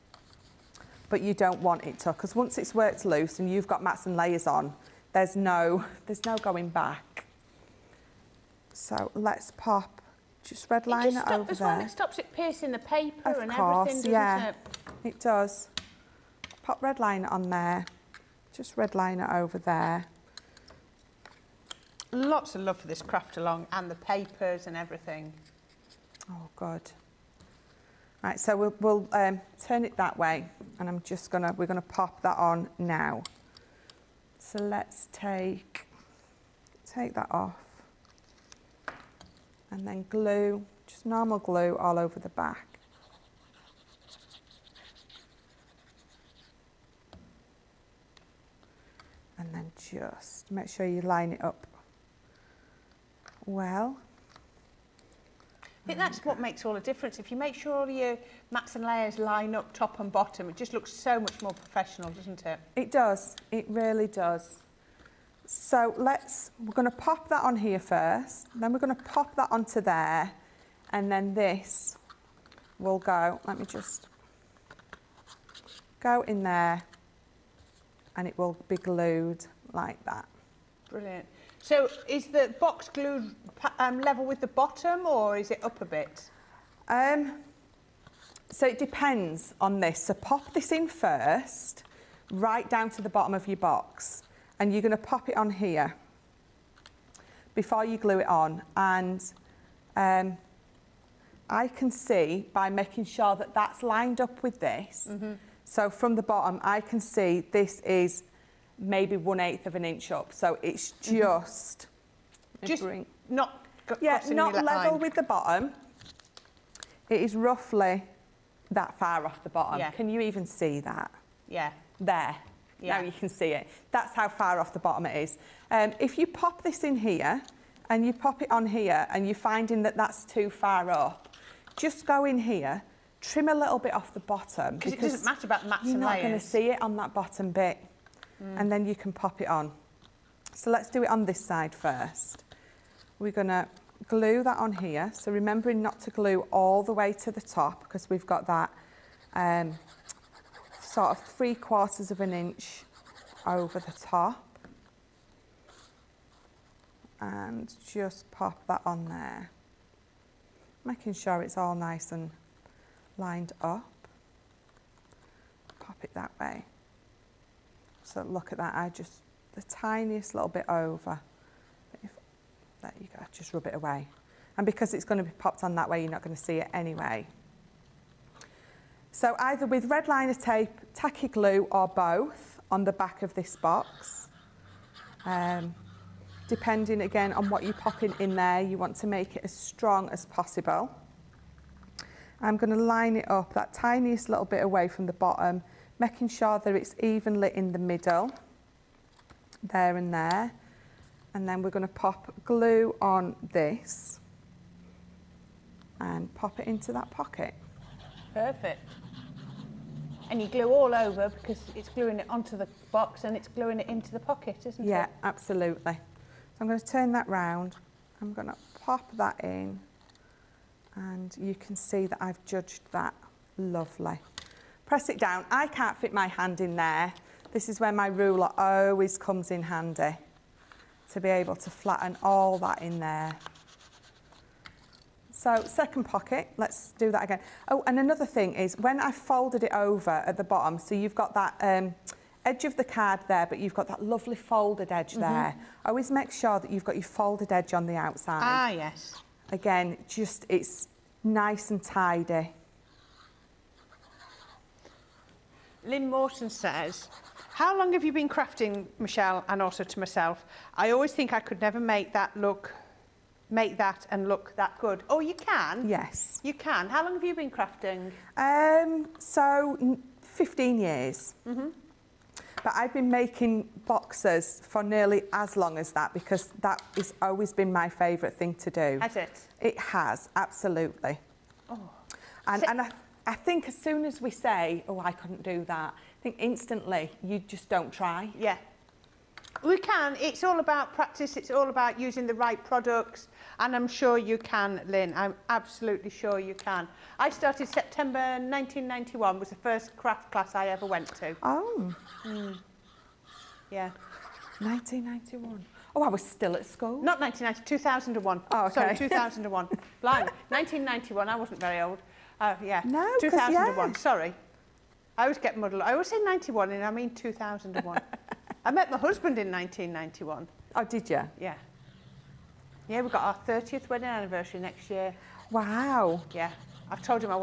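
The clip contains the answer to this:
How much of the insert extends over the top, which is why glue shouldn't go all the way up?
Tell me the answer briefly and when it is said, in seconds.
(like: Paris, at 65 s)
3/4 of an inch, at 151 s.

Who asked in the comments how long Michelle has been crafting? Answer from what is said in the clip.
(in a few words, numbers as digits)
Lynn Morton.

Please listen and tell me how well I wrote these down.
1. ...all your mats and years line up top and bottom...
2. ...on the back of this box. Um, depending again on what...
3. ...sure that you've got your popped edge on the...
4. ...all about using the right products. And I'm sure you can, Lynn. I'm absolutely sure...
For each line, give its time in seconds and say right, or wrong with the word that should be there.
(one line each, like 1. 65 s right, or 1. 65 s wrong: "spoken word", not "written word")
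1. 57 s wrong: "layers", not "years"
2. 182 s right
3. 246 s wrong: "folded", not "popped"
4. 291 s right.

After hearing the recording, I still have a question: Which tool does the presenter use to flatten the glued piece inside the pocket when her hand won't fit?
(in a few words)
Ruler.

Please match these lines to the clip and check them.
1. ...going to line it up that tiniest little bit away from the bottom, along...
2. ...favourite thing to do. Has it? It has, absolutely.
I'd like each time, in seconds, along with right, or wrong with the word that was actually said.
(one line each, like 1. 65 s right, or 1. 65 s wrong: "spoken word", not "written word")
1. 192 s wrong: "making", not "along"
2. 277 s right.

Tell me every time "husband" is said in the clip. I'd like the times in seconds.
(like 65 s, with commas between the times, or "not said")
318 s.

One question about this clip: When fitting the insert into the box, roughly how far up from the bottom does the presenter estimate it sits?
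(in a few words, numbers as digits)
1/8 of an inch.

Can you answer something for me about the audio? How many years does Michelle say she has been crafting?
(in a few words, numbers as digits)
15 years.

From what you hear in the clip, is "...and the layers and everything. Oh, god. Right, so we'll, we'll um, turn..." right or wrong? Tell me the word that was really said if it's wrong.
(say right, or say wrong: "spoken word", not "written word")
wrong: "papers", not "layers".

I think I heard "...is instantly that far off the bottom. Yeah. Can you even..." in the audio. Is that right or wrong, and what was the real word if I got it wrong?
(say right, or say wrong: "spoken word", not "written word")
wrong: "roughly", not "instantly".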